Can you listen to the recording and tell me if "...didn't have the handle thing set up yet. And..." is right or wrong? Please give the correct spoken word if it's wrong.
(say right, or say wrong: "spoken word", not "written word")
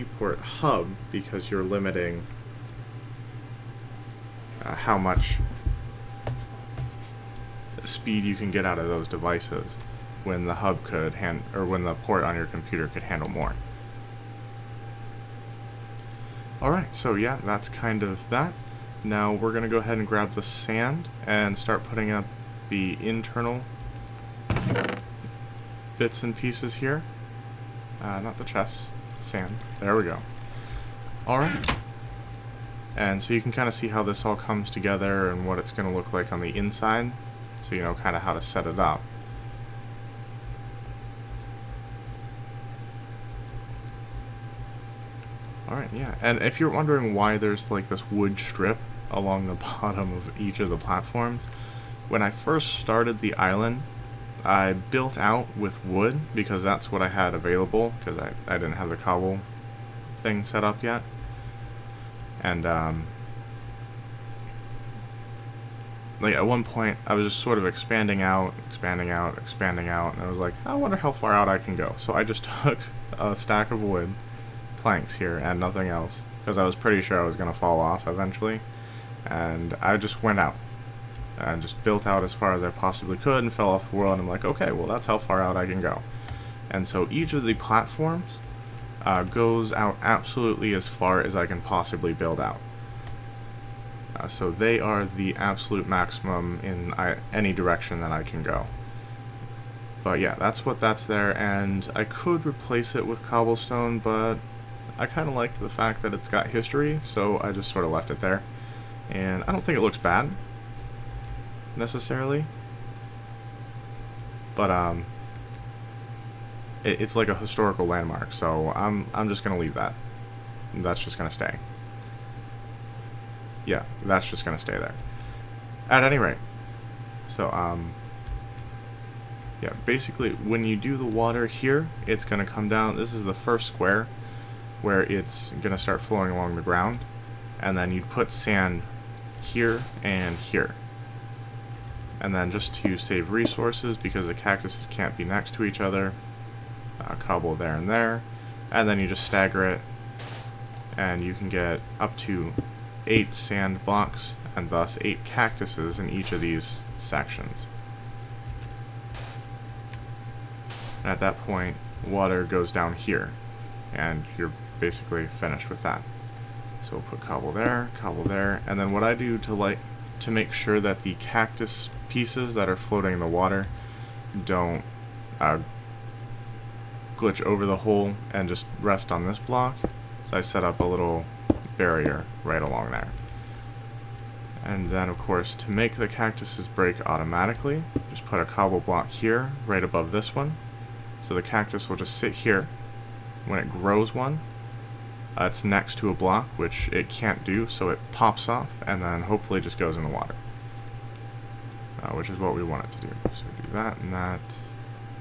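wrong: "cobble", not "handle".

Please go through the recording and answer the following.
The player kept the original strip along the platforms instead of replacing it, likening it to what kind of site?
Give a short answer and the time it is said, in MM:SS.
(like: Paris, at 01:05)
historical landmark, at 01:57.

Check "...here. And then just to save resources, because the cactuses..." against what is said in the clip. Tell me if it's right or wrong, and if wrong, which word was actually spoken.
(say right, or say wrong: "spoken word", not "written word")
right.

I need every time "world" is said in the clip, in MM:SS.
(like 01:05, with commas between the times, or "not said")
01:23.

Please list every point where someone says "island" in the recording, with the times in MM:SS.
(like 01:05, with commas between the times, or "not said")
00:53.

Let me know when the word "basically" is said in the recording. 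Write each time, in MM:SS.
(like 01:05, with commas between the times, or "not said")
02:09, 02:44.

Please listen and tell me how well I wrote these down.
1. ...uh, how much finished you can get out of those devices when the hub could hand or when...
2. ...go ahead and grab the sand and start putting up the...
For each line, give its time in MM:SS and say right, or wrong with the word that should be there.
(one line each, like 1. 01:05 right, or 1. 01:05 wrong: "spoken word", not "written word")
1. 00:04 wrong: "speed", not "finished"
2. 00:19 right.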